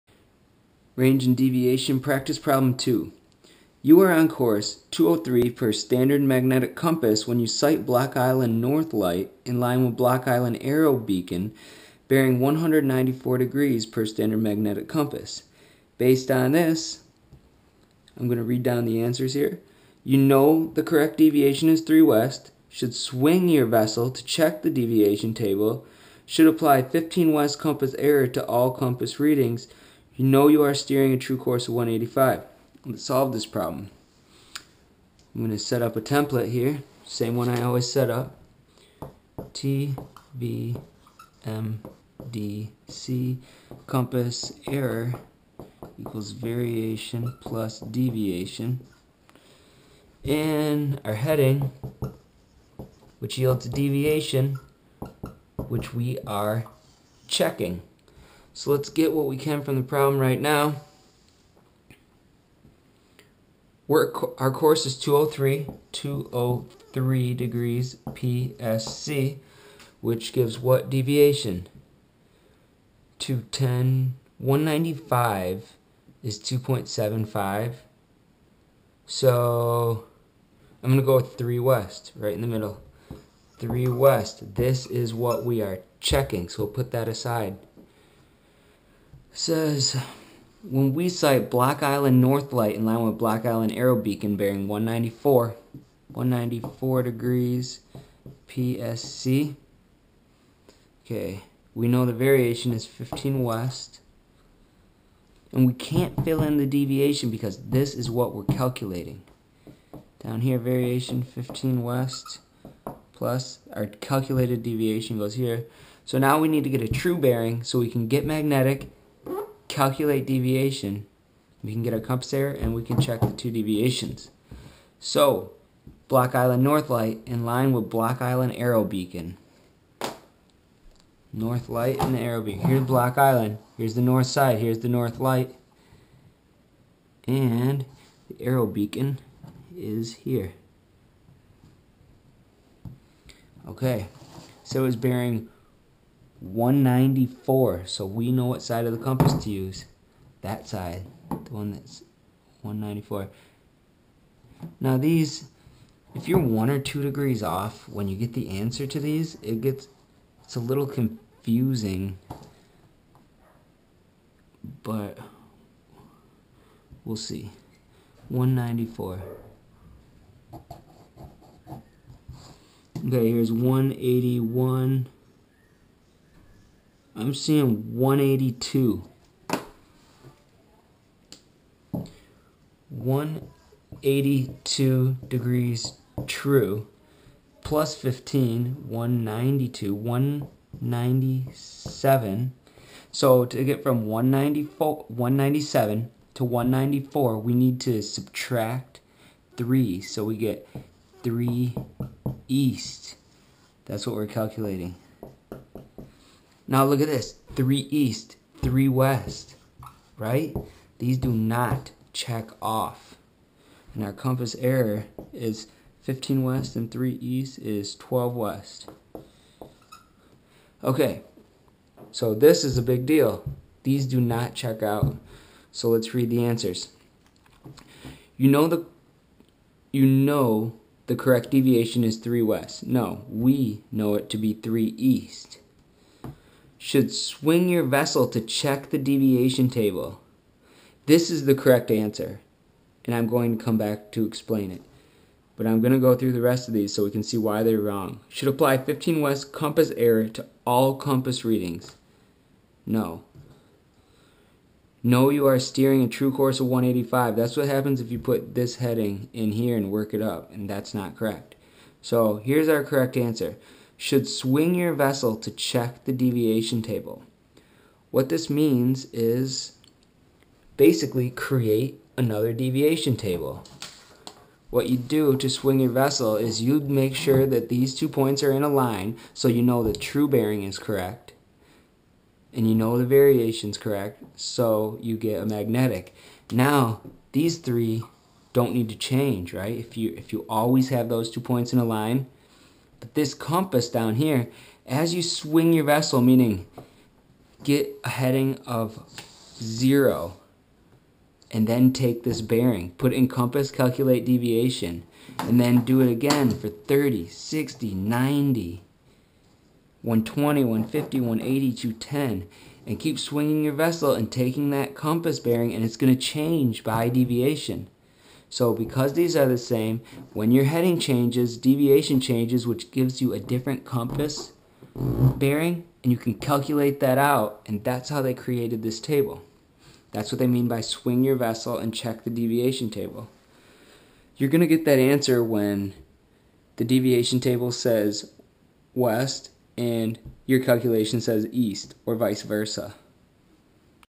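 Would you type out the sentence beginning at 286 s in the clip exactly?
Now, these three don't need to change, right?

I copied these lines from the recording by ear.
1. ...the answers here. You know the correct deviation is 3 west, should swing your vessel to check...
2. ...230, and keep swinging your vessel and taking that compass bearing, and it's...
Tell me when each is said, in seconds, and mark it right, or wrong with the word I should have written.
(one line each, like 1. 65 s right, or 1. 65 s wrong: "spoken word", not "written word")
1. 18 s right
2. 311 s wrong: "210", not "230".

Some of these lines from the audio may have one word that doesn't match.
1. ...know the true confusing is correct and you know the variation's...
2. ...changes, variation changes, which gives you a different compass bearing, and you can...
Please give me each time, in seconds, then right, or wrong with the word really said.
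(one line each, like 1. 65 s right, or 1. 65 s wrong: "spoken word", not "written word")
1. 279 s wrong: "bearing", not "confusing"
2. 320 s wrong: "deviation", not "variation".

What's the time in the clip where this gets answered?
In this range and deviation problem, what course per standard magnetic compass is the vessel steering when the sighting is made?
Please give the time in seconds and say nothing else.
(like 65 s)
4 s.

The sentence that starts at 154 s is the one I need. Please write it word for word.
Now these, if you're one or two degrees off when you get the answer to these, it gets, it's a little confusing.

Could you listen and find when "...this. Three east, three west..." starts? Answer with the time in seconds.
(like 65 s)
207 s.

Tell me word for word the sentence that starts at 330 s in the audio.
That's what they mean by swing your vessel and check the deviation table.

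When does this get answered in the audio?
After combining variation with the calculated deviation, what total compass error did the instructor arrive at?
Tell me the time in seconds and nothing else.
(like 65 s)
217 s.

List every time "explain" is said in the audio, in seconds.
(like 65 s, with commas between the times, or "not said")
244 s.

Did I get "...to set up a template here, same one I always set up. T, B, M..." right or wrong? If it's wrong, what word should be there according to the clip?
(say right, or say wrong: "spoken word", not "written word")
right.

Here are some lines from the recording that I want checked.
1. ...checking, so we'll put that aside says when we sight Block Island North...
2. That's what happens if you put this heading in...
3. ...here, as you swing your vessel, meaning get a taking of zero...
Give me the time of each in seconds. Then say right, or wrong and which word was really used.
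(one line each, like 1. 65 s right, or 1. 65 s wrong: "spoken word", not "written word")
1. 85 s right
2. 257 s right
3. 294 s wrong: "heading", not "taking".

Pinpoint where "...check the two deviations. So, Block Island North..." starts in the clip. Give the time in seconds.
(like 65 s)
122 s.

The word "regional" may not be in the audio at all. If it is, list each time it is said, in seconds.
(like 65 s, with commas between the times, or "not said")
not said.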